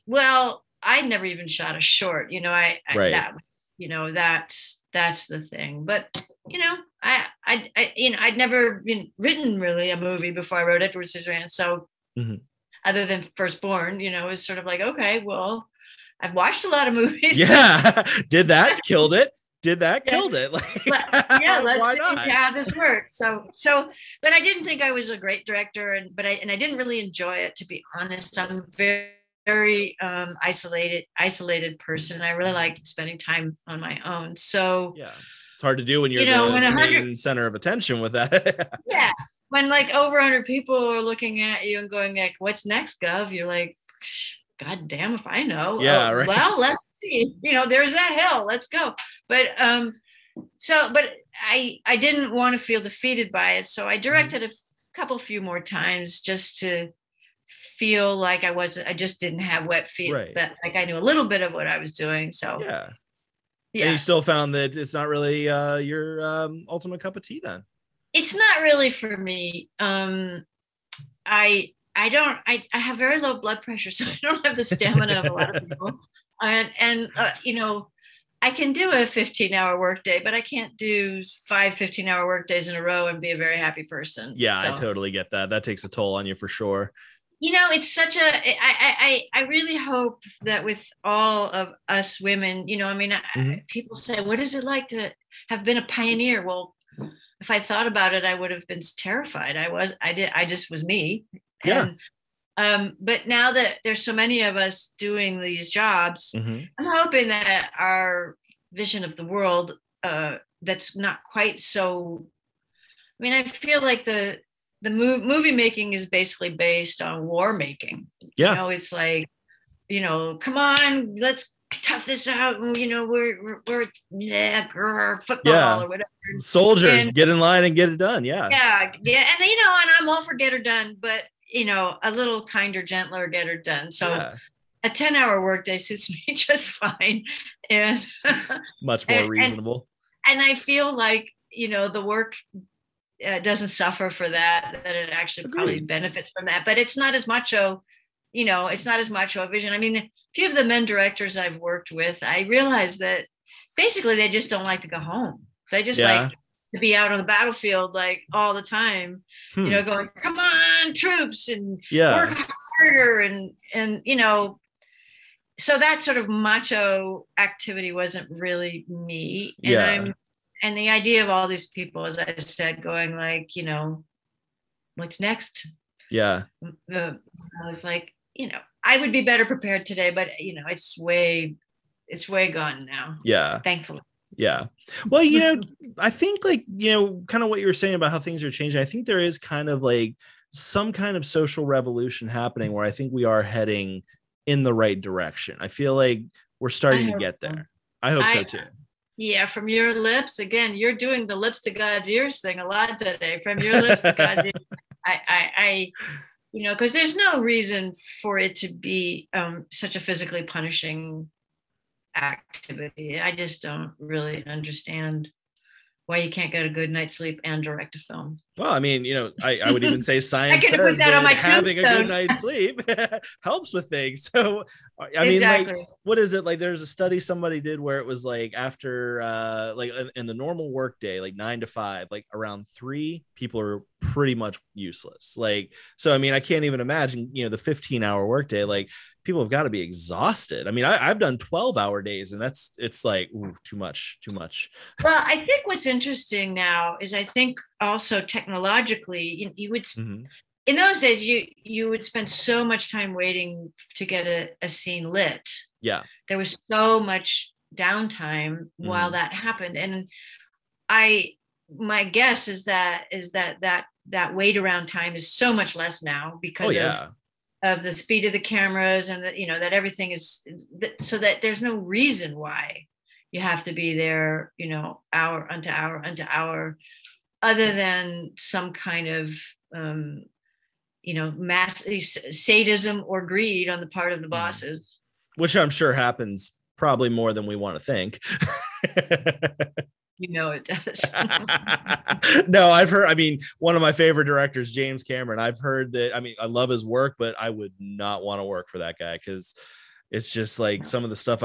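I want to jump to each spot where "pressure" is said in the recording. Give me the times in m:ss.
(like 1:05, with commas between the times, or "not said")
1:13.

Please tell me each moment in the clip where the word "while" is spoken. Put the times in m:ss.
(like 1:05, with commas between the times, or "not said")
4:18.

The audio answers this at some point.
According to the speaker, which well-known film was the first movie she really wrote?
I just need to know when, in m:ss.
0:10.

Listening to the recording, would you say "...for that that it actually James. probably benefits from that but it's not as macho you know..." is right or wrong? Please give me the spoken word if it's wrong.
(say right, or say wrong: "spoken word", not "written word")
wrong: "Agreed", not "James".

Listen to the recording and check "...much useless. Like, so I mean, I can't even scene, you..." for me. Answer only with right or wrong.
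wrong.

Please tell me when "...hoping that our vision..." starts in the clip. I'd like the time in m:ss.
1:47.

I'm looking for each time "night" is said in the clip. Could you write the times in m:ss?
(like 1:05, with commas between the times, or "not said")
3:36, 3:42.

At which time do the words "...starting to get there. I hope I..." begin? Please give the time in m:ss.
3:16.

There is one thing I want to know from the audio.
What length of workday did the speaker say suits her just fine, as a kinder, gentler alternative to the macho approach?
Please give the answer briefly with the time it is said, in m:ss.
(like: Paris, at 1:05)
10 hours, at 2:14.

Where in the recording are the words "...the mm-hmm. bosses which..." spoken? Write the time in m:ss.
4:44.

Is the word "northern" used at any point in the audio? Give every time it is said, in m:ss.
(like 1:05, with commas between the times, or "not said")
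not said.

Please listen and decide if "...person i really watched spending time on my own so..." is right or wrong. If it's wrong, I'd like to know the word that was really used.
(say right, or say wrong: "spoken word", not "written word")
wrong: "liked", not "watched".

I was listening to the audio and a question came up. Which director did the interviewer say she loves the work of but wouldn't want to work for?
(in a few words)
James Cameron.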